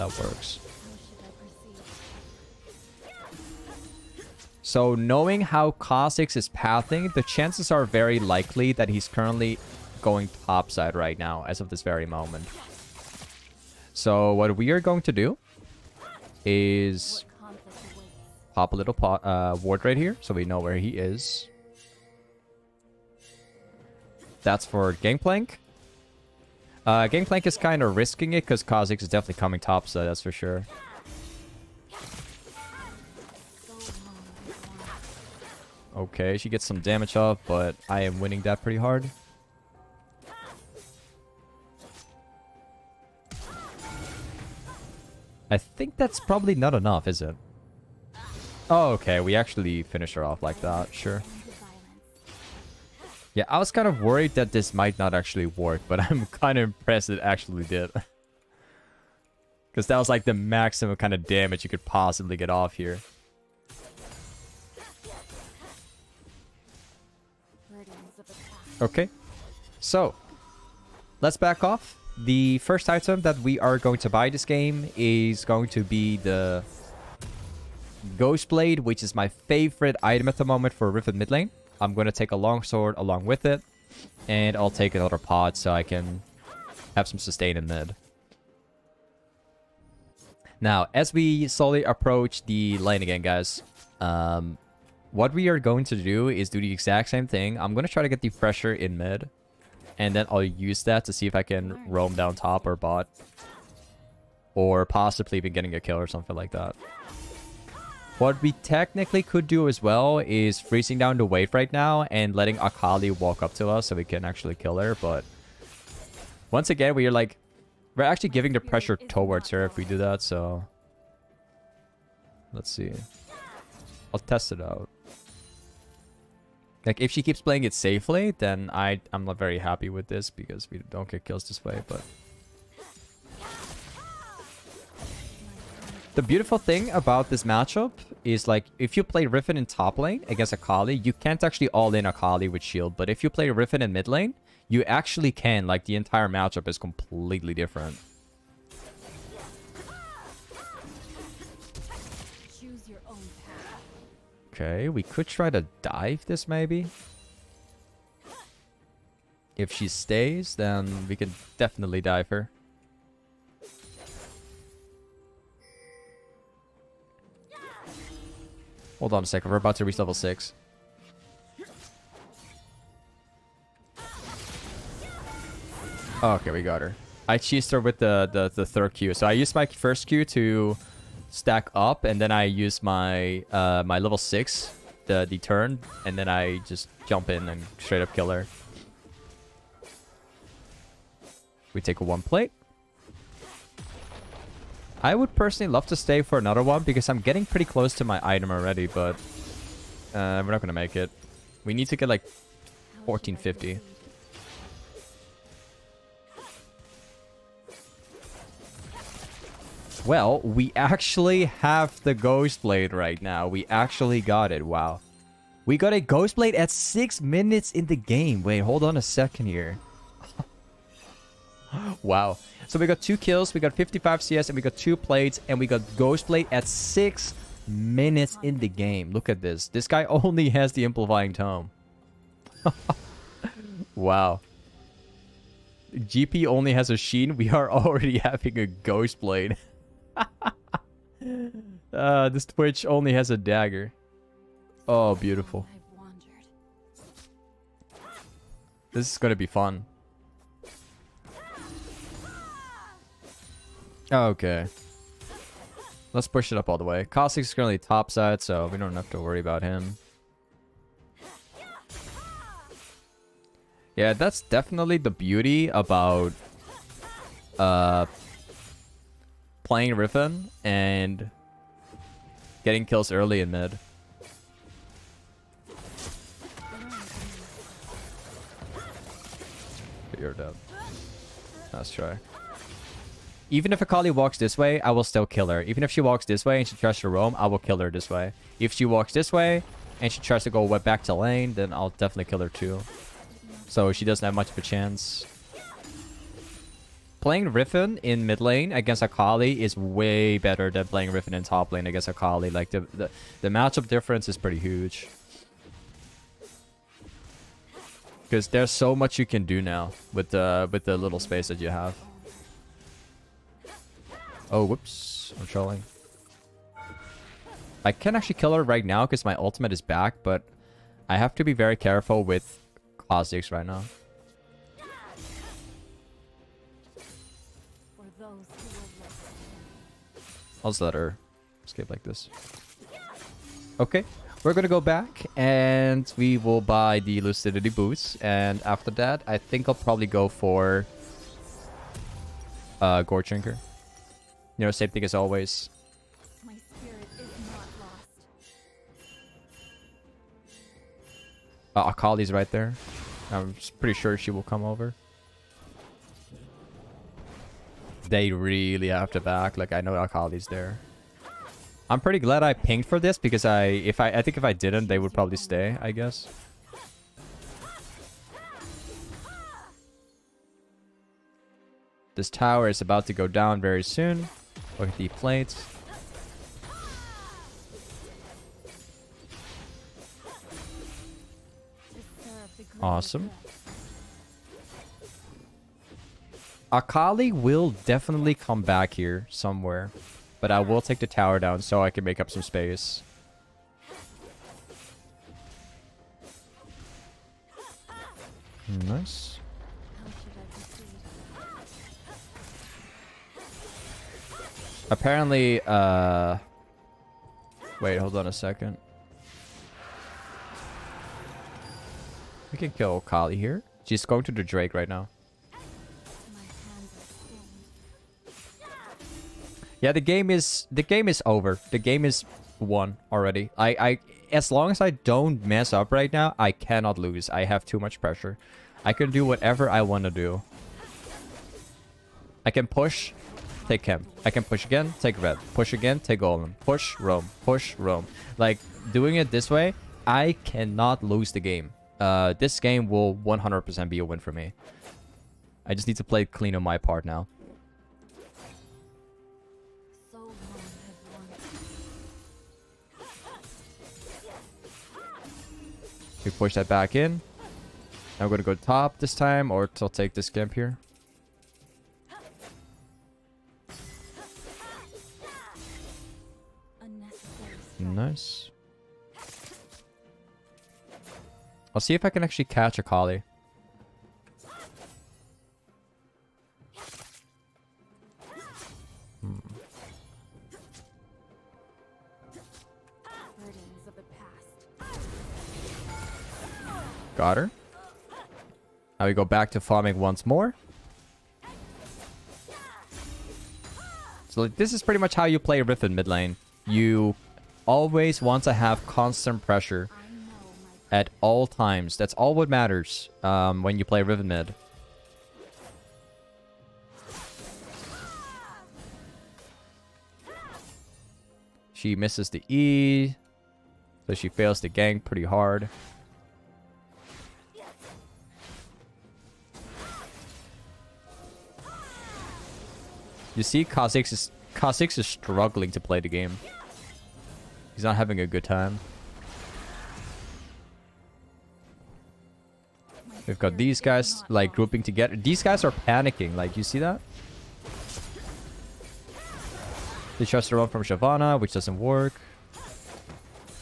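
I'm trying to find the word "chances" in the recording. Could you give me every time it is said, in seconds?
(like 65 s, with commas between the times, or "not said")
7 s, 294 s.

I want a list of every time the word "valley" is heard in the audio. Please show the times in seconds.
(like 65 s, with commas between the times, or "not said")
not said.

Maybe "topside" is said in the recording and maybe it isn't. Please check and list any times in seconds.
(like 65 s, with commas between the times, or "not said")
10 s, 257 s.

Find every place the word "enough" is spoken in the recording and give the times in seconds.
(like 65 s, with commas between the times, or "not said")
46 s.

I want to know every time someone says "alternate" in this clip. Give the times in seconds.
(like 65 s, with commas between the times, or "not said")
not said.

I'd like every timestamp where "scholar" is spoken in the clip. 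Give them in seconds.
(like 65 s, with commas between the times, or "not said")
not said.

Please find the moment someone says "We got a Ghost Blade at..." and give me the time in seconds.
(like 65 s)
215 s.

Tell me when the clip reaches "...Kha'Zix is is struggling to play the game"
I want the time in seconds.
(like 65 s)
523 s.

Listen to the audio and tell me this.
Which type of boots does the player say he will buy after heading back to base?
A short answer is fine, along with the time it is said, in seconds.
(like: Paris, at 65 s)
Lucidity boots, at 337 s.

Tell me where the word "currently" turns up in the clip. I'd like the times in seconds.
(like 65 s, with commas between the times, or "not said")
9 s, 257 s.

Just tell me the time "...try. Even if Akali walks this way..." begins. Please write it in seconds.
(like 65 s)
281 s.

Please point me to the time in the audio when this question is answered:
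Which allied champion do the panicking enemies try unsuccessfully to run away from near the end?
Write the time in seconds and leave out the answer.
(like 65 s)
540 s.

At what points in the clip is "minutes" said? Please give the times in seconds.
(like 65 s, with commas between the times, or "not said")
217 s, 227 s.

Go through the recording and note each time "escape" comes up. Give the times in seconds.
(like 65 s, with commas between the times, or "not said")
331 s.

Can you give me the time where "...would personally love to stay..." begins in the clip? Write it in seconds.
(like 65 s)
195 s.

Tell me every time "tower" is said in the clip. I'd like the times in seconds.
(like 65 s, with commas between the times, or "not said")
372 s, 391 s.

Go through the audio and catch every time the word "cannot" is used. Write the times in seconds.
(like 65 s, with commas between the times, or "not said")
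426 s, 440 s.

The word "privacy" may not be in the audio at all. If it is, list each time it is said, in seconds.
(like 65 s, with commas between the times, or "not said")
not said.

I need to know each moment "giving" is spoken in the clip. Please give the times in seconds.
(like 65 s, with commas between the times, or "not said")
118 s.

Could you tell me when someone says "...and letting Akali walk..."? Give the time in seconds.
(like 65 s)
112 s.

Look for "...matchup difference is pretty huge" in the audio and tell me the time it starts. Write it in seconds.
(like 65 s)
303 s.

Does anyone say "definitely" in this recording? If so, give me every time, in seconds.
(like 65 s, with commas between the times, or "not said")
29 s, 161 s, 264 s, 291 s, 387 s.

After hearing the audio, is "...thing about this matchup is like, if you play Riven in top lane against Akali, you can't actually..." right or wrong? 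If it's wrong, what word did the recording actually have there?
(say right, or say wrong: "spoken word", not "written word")
right.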